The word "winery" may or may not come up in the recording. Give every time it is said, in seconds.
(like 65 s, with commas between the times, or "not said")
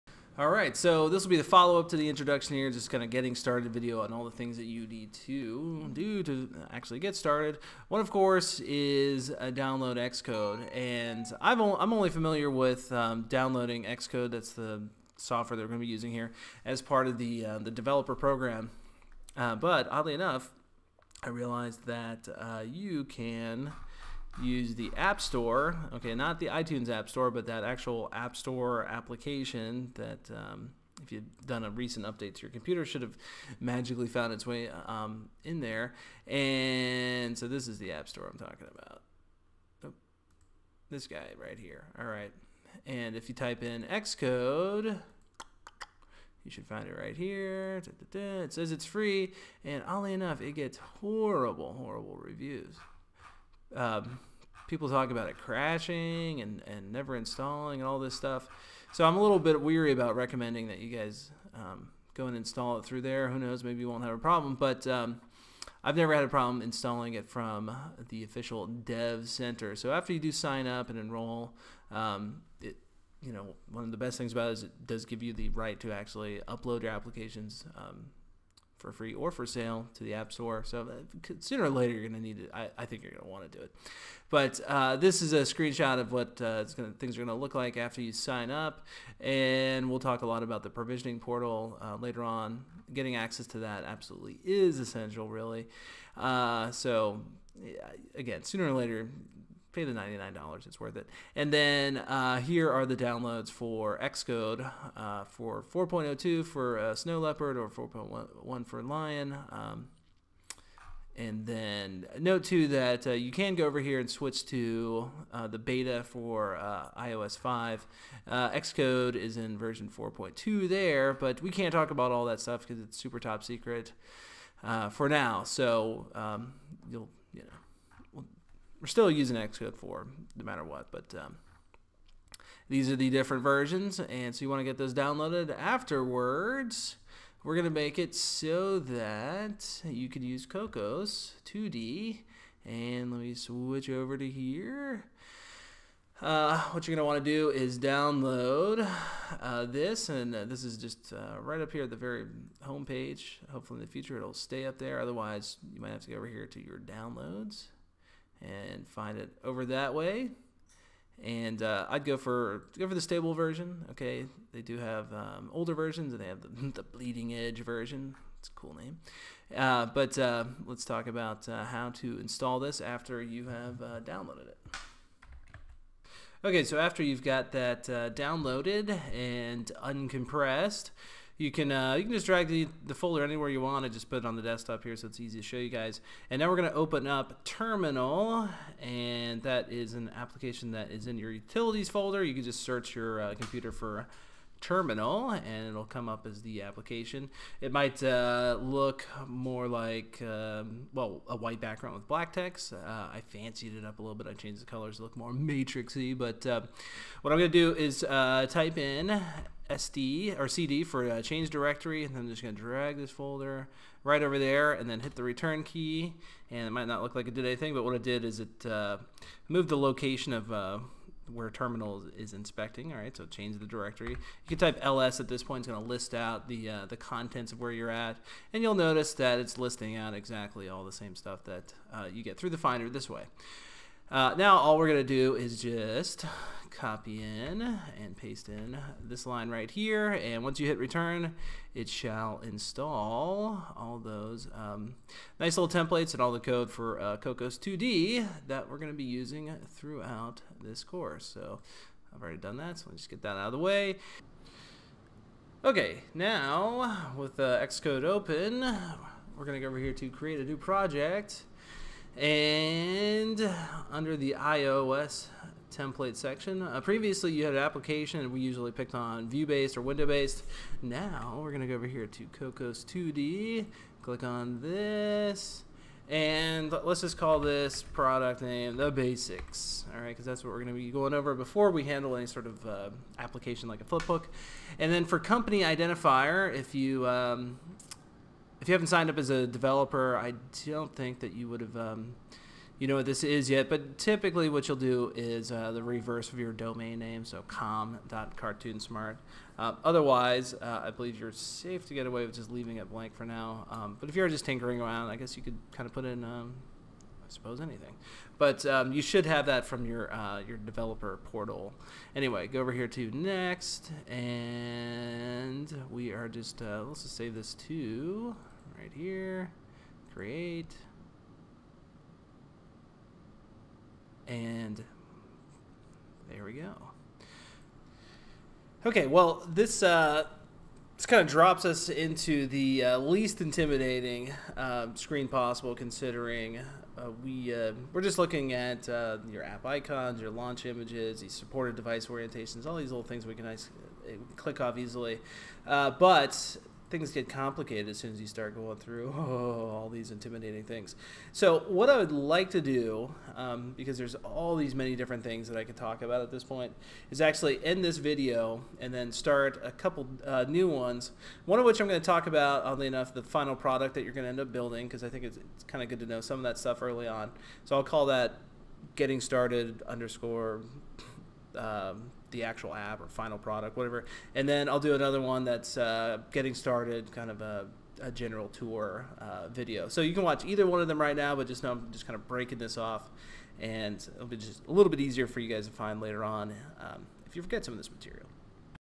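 not said.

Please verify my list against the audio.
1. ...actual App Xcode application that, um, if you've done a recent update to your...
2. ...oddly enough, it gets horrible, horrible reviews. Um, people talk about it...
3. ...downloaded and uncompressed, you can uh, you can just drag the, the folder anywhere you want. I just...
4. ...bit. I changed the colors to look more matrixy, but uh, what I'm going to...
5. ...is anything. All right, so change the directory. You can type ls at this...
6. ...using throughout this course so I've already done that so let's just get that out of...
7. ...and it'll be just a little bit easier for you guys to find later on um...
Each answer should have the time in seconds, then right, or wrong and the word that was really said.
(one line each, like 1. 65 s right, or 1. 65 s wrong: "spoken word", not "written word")
1. 27 s wrong: "Store", not "Xcode"
2. 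49 s right
3. 178 s right
4. 204 s right
5. 222 s wrong: "inspecting", not "anything"
6. 249 s right
7. 383 s right.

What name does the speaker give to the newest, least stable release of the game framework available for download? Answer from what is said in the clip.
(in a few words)
bleeding edge version.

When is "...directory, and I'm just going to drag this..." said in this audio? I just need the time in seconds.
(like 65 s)
211 s.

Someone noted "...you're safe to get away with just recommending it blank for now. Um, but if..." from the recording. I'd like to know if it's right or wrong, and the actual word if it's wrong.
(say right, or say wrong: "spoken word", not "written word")
wrong: "leaving", not "recommending".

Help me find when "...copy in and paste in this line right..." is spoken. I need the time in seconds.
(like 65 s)
236 s.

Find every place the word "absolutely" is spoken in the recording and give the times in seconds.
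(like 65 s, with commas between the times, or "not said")
93 s.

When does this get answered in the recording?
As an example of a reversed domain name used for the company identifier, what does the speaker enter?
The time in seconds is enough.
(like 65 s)
297 s.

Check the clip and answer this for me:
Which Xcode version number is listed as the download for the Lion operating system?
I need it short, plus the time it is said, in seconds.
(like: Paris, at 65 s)
4.1, at 107 s.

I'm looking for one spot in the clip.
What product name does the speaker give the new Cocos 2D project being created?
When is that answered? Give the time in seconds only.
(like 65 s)
278 s.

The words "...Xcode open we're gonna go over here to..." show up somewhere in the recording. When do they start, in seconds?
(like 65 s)
257 s.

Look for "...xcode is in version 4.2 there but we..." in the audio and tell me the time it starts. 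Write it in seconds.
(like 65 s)
118 s.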